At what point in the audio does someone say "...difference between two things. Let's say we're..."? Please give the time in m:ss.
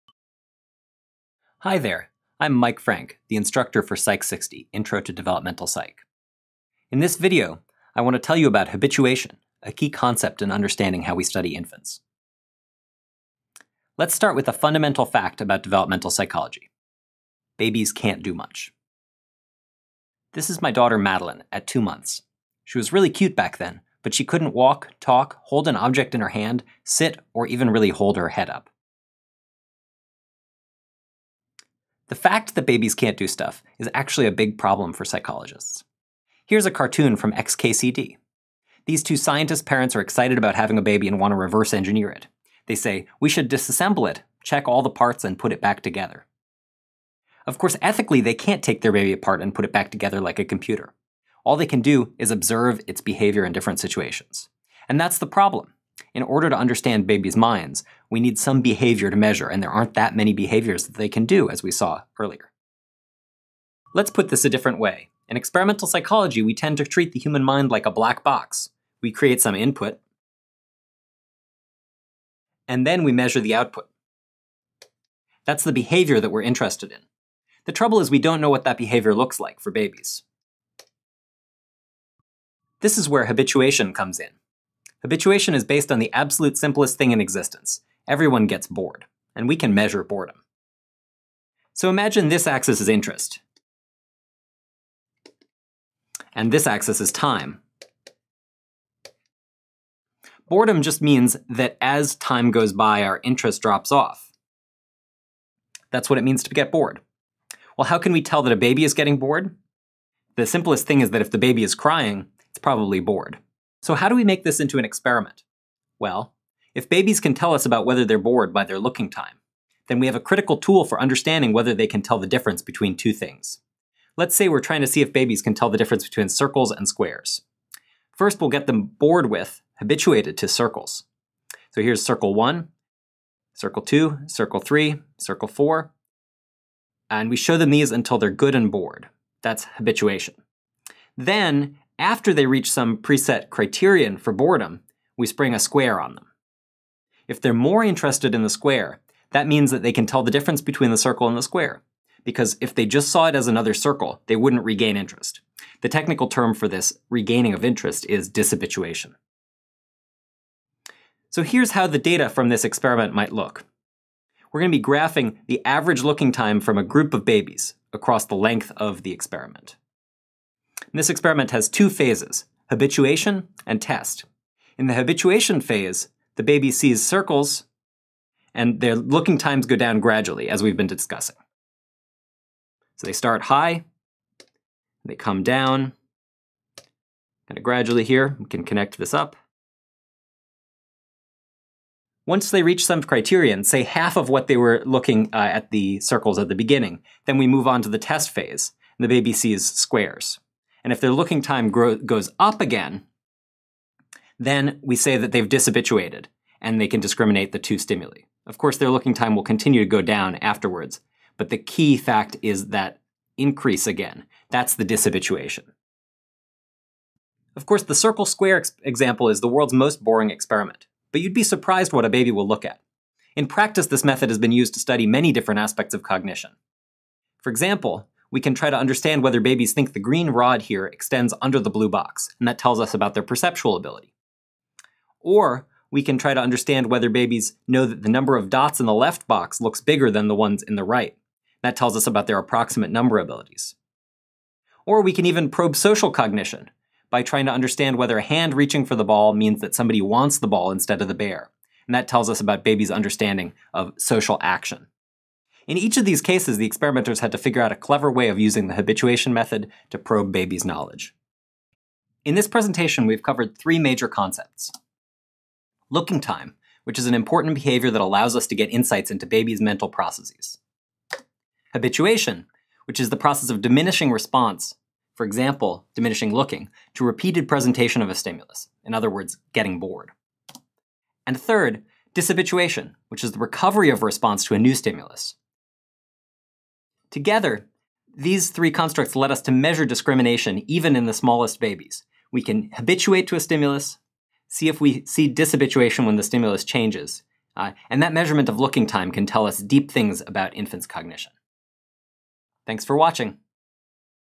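2:02.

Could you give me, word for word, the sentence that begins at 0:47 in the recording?
Of course, ethically, they can't take their baby apart and put it back together like a computer.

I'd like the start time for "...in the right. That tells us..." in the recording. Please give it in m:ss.
4:00.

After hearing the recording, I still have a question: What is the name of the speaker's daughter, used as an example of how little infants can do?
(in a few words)
Madeline.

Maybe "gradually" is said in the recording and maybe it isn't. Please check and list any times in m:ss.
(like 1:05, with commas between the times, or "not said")
3:00, 3:07.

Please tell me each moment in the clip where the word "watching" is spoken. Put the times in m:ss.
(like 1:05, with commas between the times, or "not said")
5:02.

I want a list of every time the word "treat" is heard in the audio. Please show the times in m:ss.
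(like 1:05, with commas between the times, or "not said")
1:06.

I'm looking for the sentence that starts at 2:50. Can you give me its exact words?
And this experiment has two phases, habituation and test.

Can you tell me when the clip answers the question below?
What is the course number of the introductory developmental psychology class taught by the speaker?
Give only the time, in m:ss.
0:03.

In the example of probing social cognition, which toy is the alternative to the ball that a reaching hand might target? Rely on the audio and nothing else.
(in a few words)
The bear.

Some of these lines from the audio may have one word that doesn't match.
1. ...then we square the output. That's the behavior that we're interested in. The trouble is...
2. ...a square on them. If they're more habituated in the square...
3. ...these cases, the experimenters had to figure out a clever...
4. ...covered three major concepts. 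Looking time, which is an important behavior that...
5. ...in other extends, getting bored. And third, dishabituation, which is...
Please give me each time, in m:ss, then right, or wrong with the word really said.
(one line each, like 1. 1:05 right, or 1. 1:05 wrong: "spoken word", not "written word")
1. 1:12 wrong: "measure", not "square"
2. 2:25 wrong: "interested", not "habituated"
3. 4:16 right
4. 4:23 right
5. 4:38 wrong: "words", not "extends".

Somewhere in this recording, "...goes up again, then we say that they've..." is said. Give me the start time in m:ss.
3:21.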